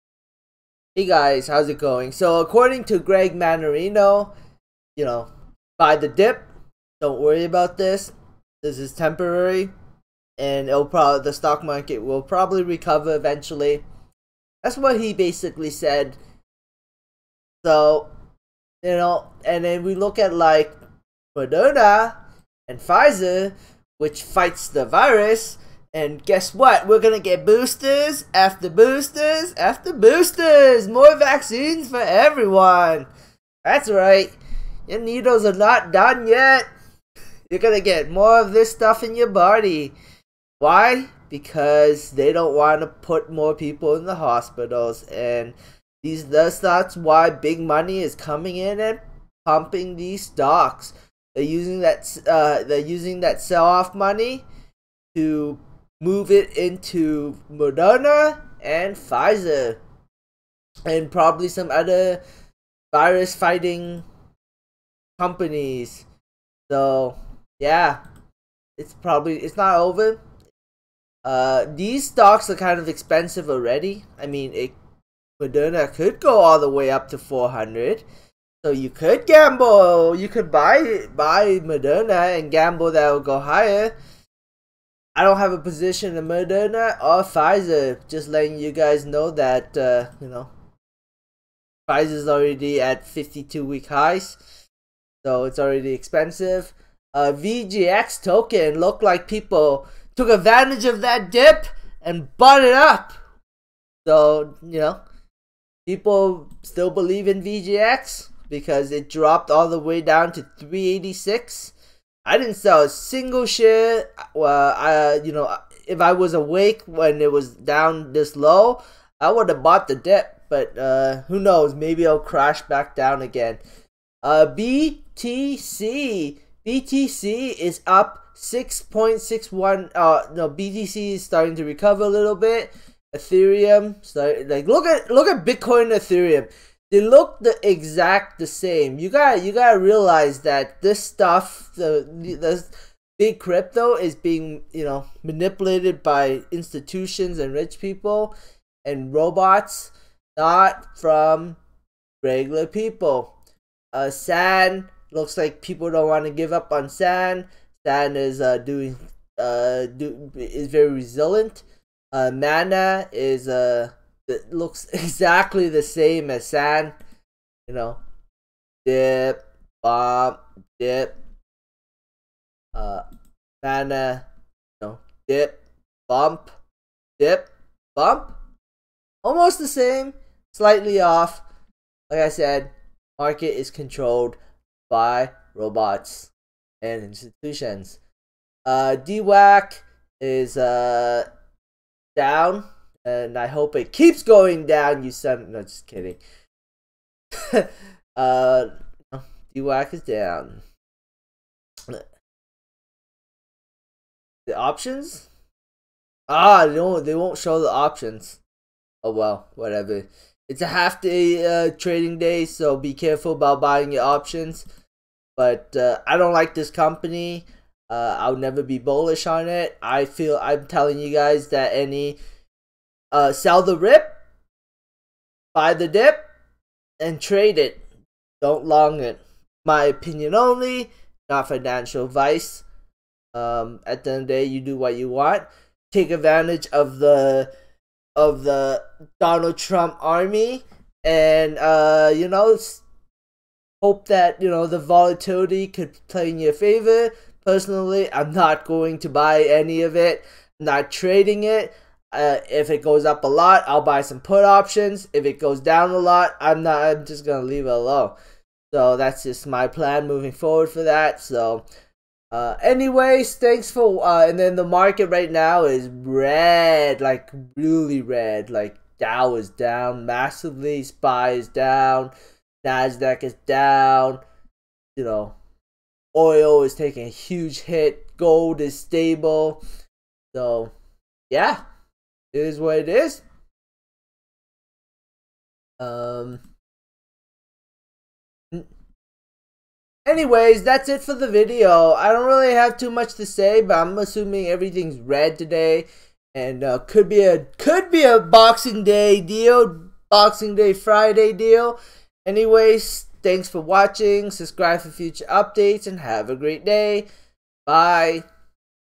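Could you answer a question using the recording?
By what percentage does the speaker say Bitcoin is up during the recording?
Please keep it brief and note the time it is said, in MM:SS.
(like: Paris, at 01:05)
6.61, at 02:08.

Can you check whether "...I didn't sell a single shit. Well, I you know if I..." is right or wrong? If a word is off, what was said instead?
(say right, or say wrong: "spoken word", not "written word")
right.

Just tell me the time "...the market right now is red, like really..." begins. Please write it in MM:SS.
04:24.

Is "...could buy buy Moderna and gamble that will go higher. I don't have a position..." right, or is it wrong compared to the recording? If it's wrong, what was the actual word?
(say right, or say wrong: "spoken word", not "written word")
right.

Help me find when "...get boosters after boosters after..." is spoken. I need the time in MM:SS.
00:27.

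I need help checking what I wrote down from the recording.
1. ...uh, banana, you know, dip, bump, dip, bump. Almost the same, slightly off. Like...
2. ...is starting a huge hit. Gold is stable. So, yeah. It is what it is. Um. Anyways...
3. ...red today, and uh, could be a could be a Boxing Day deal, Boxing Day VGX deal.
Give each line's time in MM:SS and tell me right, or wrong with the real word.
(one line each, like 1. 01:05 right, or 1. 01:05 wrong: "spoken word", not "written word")
1. 02:52 right
2. 04:36 wrong: "taking", not "starting"
3. 04:54 wrong: "Friday", not "VGX".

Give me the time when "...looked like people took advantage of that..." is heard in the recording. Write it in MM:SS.
01:38.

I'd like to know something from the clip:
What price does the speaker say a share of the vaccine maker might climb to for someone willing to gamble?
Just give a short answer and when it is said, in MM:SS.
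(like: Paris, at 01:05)
400, at 01:17.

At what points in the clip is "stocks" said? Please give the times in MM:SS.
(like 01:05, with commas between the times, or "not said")
00:11, 00:50, 01:12.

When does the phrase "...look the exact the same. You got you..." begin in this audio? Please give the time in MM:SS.
02:17.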